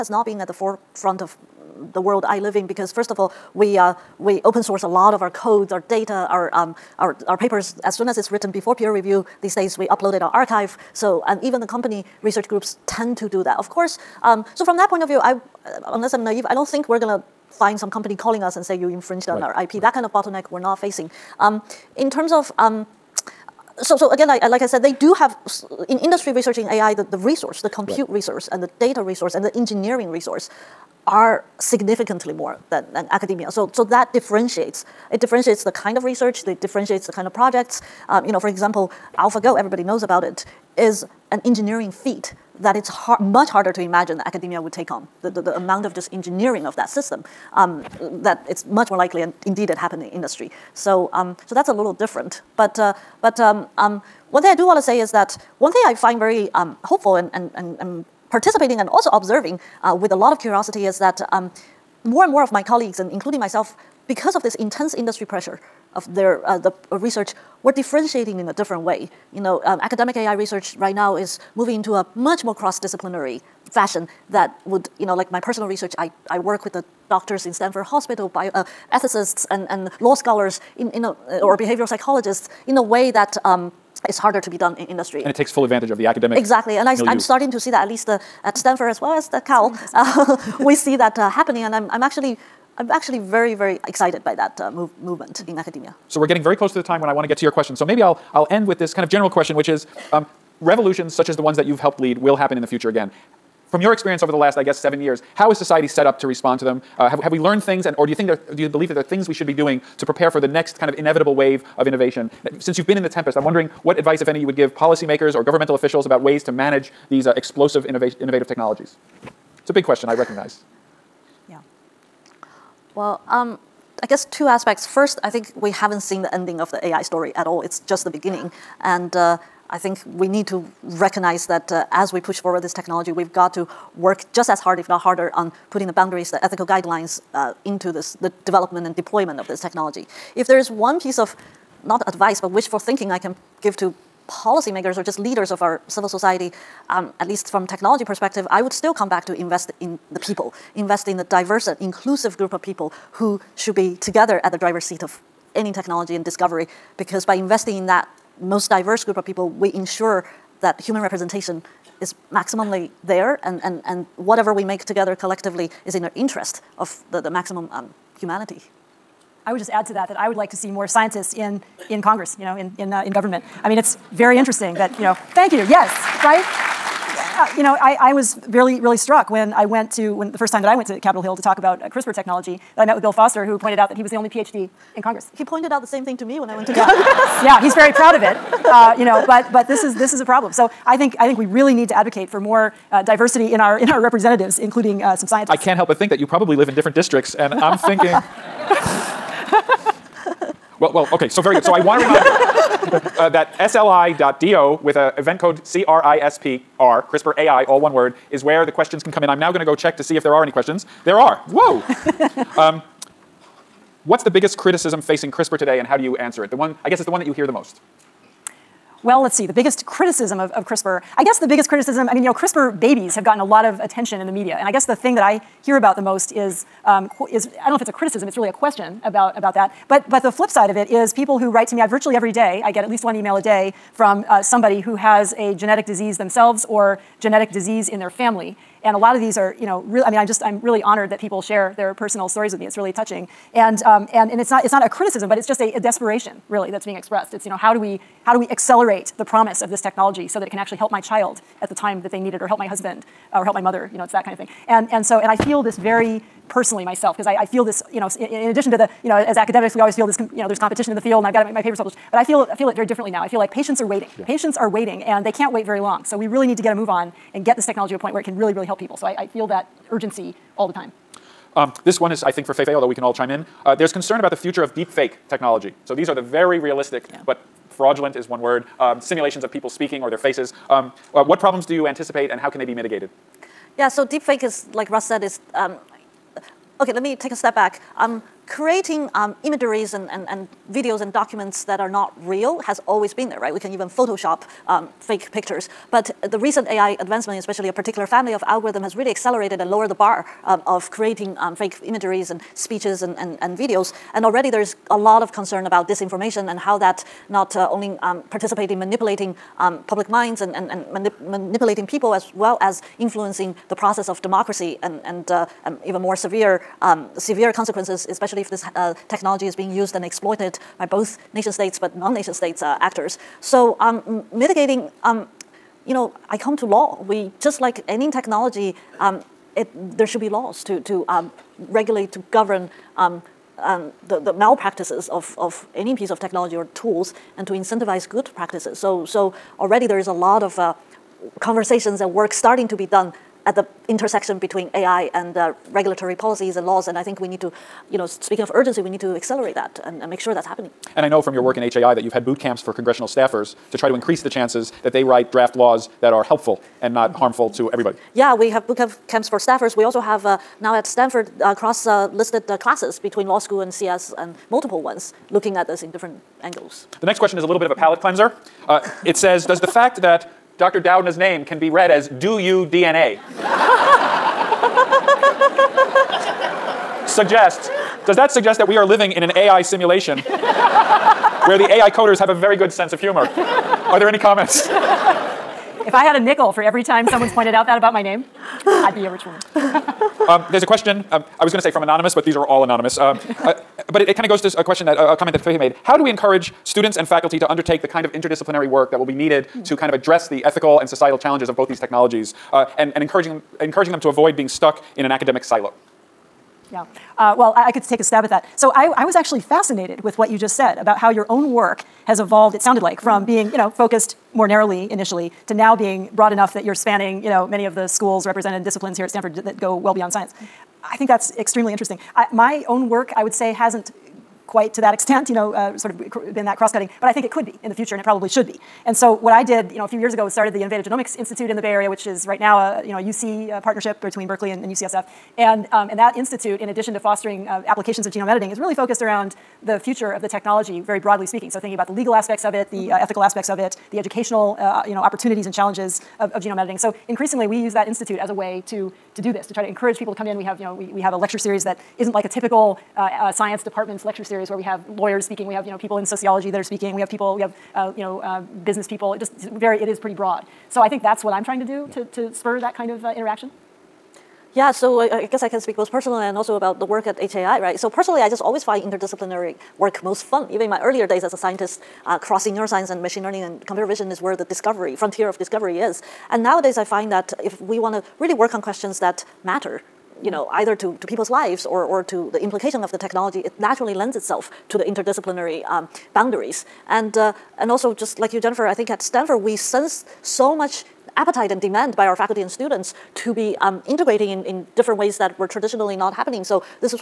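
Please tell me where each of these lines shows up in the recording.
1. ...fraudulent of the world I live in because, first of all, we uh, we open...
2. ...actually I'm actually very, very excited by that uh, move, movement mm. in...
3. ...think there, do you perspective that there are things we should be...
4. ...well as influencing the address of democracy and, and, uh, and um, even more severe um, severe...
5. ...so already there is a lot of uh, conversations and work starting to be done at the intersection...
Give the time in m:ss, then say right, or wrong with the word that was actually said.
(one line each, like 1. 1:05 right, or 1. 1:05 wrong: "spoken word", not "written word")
1. 0:00 wrong: "forefront", not "fraudulent"
2. 1:32 right
3. 1:48 wrong: "believe", not "perspective"
4. 5:12 wrong: "process", not "address"
5. 5:39 right.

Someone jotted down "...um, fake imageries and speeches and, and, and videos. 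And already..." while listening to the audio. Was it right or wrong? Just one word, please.
right.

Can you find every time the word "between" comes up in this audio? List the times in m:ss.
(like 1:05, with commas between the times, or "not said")
5:44, 6:03, 7:14.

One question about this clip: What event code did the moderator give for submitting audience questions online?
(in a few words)
CRISPR AI.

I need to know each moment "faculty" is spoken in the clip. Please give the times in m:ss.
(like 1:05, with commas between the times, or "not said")
6:37, 8:12.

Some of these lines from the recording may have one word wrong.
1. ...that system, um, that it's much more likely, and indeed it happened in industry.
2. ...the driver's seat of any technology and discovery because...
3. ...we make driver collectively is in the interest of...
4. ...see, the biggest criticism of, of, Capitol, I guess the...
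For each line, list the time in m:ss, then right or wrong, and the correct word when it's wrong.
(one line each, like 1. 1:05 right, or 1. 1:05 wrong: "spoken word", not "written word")
1. 0:46 right
2. 2:34 right
3. 2:44 wrong: "together", not "driver"
4. 3:39 wrong: "CRISPR", not "Capitol".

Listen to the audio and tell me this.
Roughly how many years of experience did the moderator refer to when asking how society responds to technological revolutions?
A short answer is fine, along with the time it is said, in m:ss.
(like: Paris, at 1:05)
7, at 1:44.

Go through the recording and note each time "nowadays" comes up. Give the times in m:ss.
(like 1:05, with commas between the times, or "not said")
7:56.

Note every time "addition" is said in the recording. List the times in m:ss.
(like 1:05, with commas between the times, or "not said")
4:18, 7:16.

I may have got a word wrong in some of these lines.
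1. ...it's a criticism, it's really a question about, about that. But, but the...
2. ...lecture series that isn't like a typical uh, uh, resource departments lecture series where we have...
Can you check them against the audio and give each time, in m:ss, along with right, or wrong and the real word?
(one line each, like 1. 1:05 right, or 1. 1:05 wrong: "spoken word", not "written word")
1. 3:47 right
2. 7:31 wrong: "science", not "resource".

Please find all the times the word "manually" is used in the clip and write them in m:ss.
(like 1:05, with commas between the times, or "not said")
not said.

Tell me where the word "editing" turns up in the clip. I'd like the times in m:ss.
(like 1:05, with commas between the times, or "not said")
7:18, 7:26.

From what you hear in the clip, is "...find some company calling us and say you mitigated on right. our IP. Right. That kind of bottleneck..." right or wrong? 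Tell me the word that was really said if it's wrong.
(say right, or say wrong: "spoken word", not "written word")
wrong: "infringed", not "mitigated".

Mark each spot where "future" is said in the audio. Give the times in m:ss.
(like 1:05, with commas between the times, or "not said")
1:42, 4:34, 7:07, 7:19.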